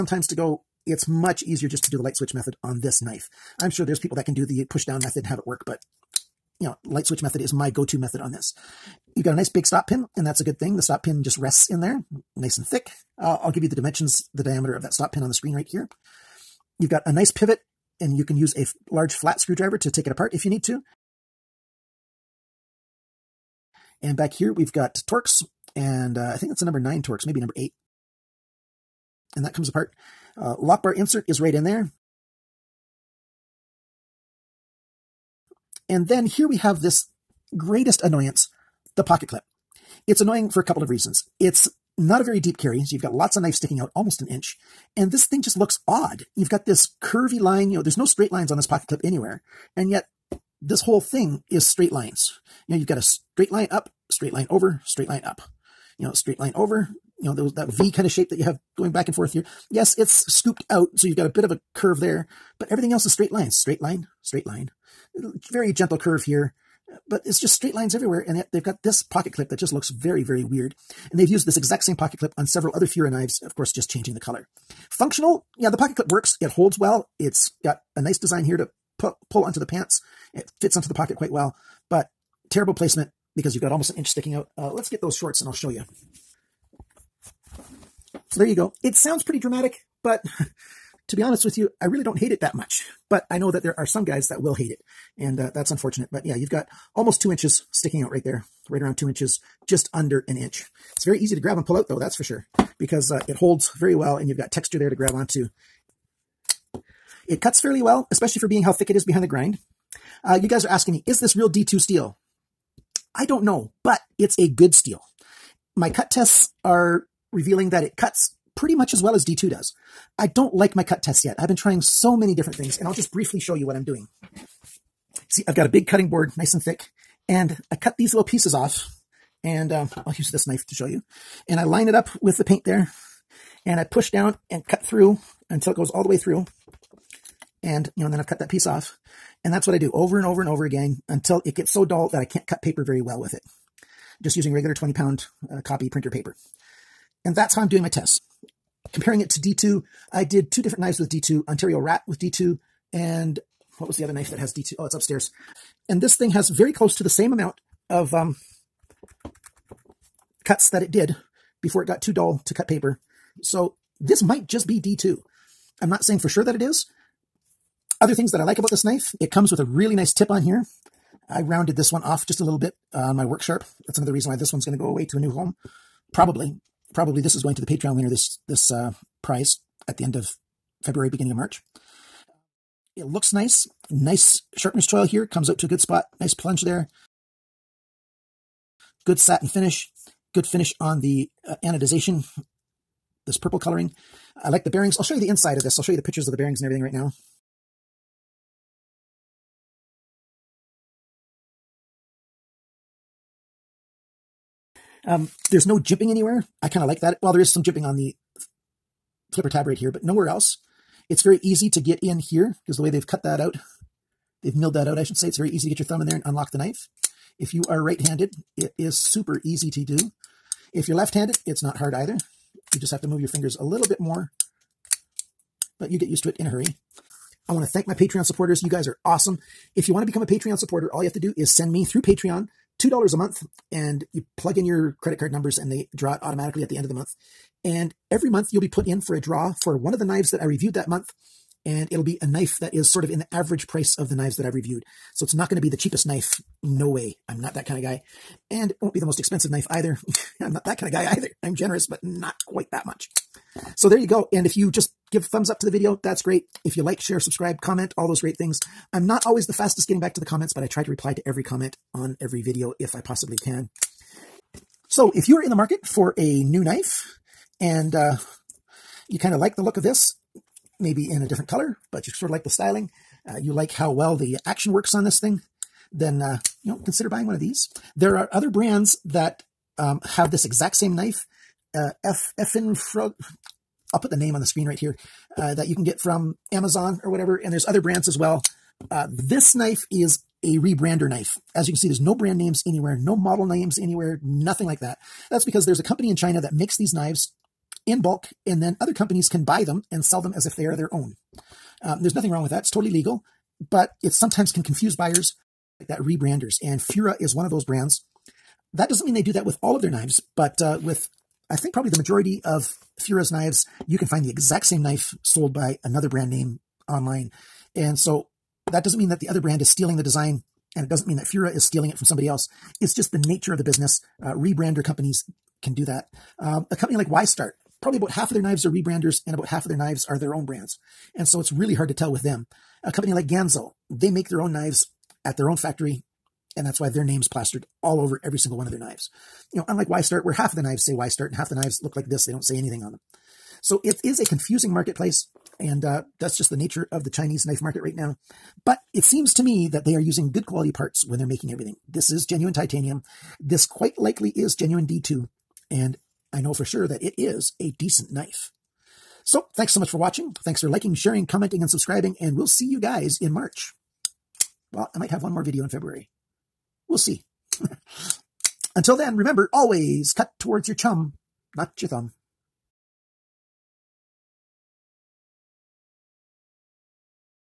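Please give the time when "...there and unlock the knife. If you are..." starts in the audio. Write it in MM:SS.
03:36.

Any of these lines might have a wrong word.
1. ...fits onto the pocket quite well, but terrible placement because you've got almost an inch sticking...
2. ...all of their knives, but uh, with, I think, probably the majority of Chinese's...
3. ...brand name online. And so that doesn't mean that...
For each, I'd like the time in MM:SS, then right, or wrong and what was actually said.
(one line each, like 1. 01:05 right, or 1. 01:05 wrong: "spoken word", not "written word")
1. 01:20 right
2. 05:09 wrong: "Fura", not "Chinese"
3. 05:16 right.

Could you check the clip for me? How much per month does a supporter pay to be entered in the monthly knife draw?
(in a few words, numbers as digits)
$2.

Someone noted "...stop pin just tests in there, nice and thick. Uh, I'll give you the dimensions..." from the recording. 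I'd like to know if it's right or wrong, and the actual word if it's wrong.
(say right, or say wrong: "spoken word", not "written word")
wrong: "rests", not "tests".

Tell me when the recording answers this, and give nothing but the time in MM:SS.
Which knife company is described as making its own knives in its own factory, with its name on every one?
05:33.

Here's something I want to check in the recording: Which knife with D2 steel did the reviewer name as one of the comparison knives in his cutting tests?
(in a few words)
Ontario Rat.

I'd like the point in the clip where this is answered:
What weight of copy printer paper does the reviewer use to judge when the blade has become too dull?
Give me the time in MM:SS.
02:24.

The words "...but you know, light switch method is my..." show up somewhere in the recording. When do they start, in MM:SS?
00:05.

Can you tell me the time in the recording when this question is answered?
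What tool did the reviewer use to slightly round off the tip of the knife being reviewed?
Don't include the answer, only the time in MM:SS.
02:53.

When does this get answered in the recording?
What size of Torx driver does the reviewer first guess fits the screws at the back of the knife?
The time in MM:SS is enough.
00:26.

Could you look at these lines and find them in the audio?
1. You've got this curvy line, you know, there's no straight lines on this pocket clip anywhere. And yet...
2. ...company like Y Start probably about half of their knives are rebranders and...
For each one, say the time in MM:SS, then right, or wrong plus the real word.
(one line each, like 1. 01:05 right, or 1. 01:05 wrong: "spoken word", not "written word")
1. 00:46 right
2. 05:26 right.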